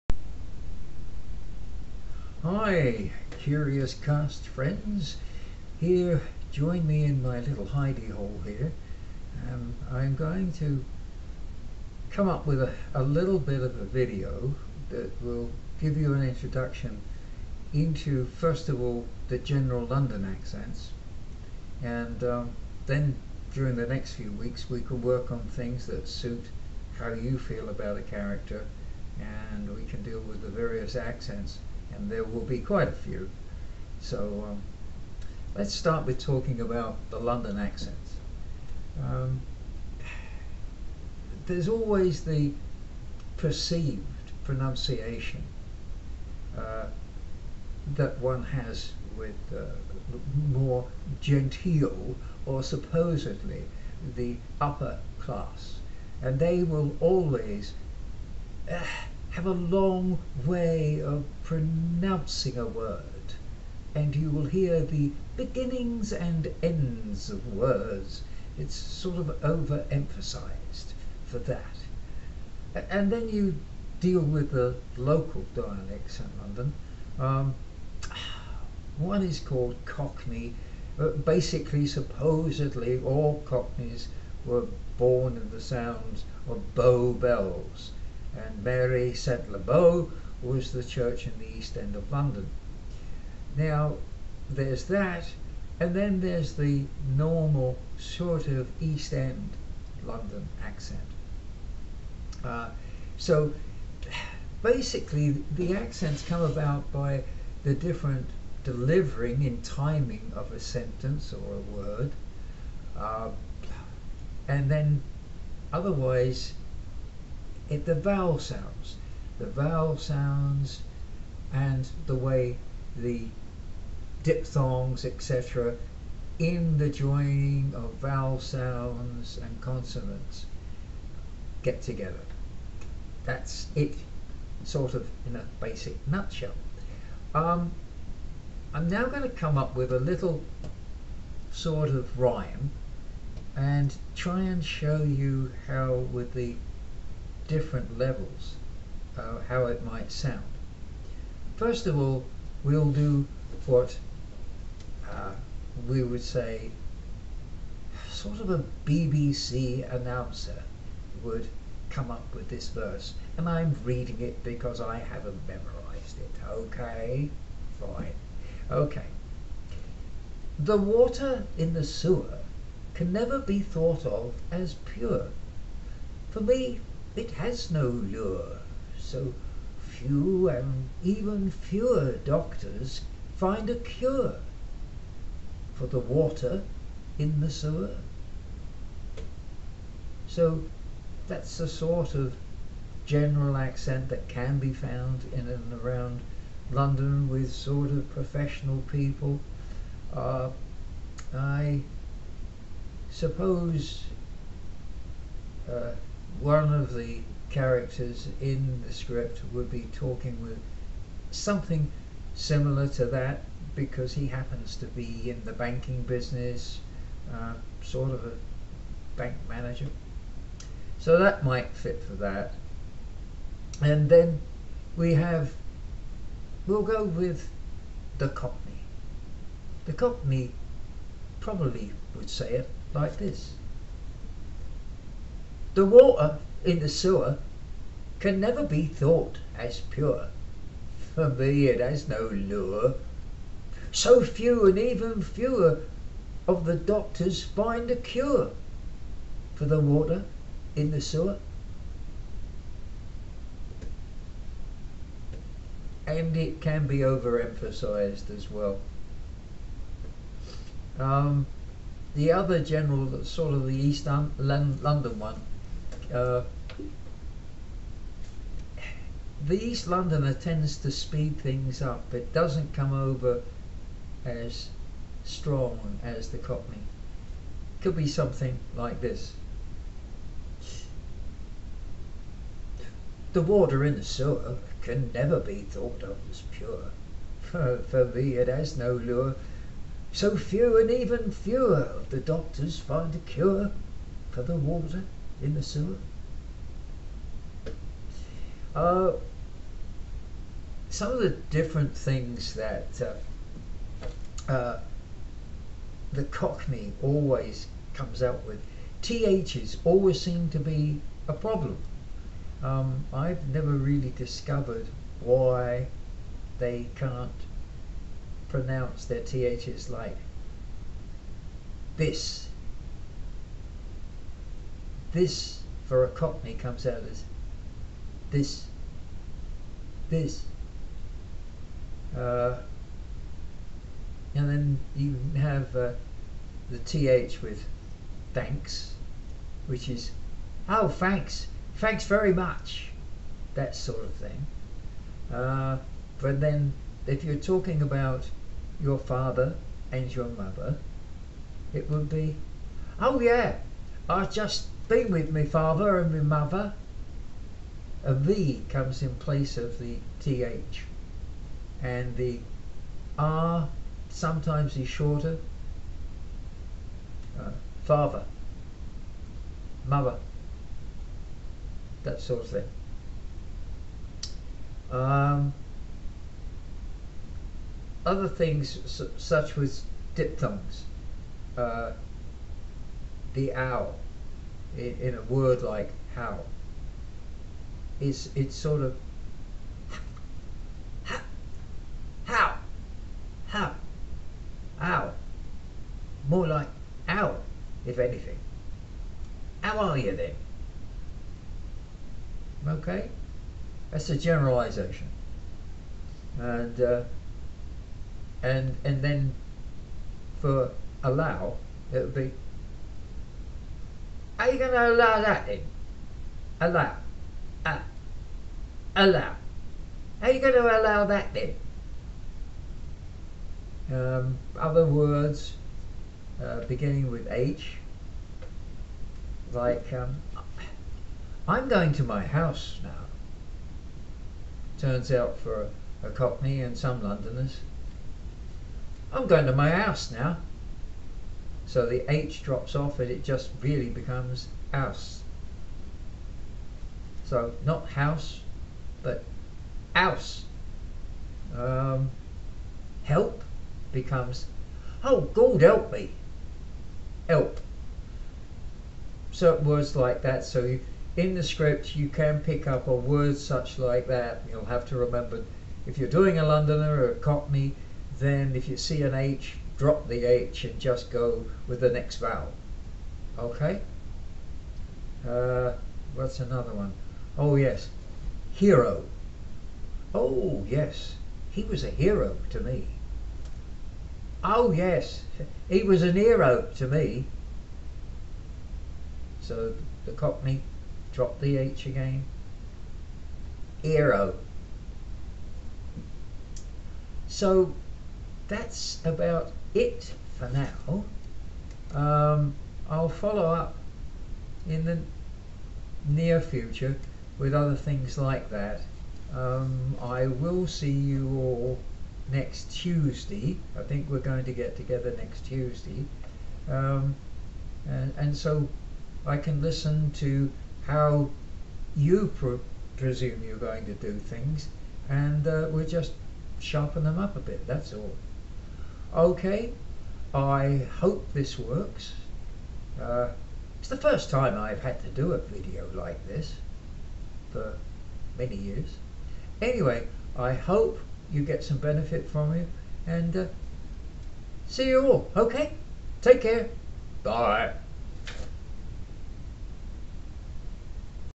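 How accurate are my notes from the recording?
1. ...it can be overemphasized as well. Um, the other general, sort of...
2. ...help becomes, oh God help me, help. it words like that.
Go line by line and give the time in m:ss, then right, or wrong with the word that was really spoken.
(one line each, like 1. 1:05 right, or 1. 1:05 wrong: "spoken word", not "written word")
1. 4:16 right
2. 7:33 right.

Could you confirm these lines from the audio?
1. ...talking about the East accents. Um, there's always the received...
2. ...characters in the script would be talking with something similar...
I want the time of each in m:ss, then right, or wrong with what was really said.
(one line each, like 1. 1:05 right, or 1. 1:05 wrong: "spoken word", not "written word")
1. 0:36 wrong: "London", not "East"
2. 3:27 right.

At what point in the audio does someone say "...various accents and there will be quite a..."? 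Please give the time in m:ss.
0:30.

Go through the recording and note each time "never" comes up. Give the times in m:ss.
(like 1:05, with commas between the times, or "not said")
2:53, 3:58, 4:45, 5:13.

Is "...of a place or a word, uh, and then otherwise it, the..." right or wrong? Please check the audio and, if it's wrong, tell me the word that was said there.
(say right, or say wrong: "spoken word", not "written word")
wrong: "sentence", not "place".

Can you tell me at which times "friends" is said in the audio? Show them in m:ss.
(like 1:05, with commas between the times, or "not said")
0:04.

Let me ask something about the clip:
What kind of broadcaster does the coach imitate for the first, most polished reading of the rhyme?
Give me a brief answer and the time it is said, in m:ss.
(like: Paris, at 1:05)
BBC announcer, at 2:38.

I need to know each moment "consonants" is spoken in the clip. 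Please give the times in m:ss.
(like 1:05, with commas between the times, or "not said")
2:09.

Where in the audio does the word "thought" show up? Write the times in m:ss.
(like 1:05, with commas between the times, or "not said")
2:53, 3:58, 4:45.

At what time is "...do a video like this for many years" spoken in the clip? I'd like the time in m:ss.
8:55.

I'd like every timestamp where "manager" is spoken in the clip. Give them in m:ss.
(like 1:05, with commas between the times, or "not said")
3:39.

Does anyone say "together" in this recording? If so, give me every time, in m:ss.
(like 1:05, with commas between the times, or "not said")
2:11, 8:34.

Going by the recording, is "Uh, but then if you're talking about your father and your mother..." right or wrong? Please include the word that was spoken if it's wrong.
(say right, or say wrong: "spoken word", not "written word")
right.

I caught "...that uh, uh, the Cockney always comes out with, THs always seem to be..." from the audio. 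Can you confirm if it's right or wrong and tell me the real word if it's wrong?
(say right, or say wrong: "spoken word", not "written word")
right.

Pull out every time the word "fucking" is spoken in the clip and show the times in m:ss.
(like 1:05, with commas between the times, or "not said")
not said.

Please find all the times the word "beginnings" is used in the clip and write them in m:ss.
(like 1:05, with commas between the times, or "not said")
1:05, 7:06.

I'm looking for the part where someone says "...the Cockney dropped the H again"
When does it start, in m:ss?
8:10.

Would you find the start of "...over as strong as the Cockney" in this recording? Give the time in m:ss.
4:32.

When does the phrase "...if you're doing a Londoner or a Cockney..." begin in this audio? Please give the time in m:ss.
7:45.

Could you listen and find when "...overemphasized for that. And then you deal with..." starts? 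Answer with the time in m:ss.
1:09.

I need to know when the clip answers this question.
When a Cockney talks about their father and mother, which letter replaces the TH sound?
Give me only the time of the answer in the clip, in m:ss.
5:58.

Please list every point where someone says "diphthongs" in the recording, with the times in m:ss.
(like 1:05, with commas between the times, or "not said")
2:04, 6:20.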